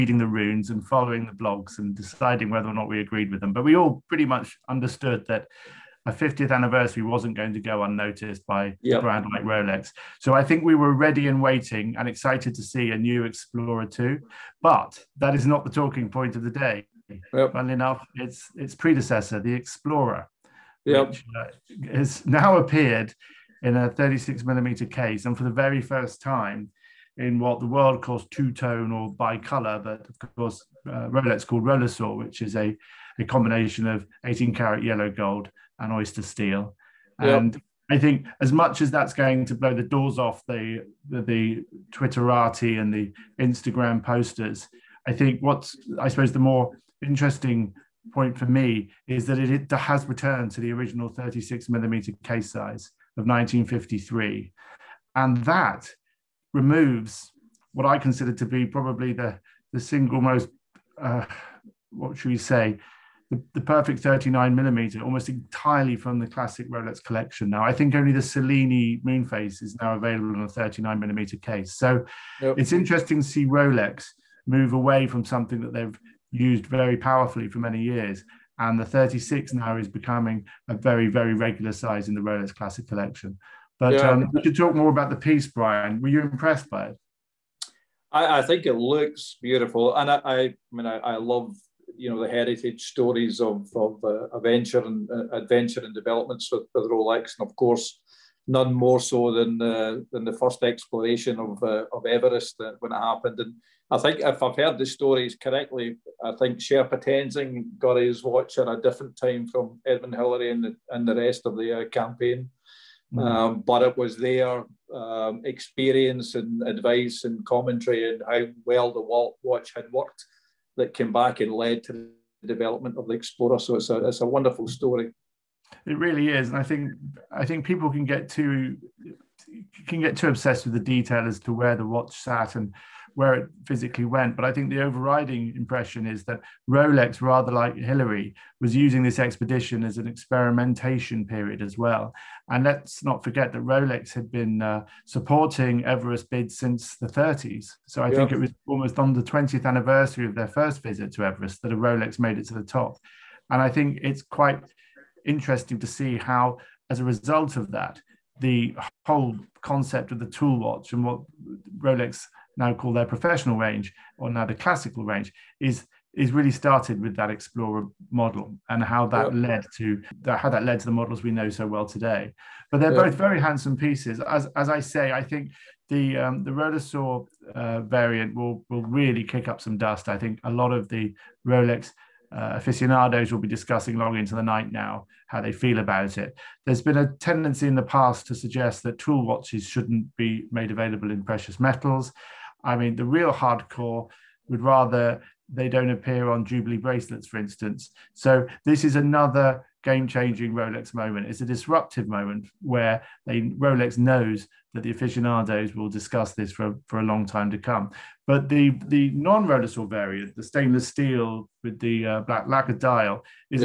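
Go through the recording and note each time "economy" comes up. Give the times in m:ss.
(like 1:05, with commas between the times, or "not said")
not said.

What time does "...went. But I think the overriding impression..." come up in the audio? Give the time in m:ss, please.
2:14.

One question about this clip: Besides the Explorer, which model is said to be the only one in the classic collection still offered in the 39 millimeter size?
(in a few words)
Cellini Moonphase.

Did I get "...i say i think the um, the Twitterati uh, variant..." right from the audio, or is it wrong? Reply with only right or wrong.
wrong.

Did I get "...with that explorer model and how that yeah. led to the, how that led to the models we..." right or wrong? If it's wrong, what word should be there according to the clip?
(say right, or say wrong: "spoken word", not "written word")
right.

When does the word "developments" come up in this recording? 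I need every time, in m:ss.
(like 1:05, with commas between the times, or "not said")
1:35, 2:02.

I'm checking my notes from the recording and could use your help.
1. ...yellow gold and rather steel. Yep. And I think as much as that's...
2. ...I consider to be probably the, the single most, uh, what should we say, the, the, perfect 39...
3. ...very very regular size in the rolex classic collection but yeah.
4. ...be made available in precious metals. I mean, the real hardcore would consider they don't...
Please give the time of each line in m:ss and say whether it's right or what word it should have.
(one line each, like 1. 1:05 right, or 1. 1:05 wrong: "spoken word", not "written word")
1. 0:34 wrong: "oyster", not "rather"
2. 0:57 right
3. 1:20 right
4. 3:10 wrong: "rather", not "consider".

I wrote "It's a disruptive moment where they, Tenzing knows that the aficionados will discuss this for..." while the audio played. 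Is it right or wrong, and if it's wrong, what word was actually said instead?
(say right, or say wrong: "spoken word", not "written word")
wrong: "Rolex", not "Tenzing".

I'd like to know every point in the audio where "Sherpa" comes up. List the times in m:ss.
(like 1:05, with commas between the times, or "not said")
1:46.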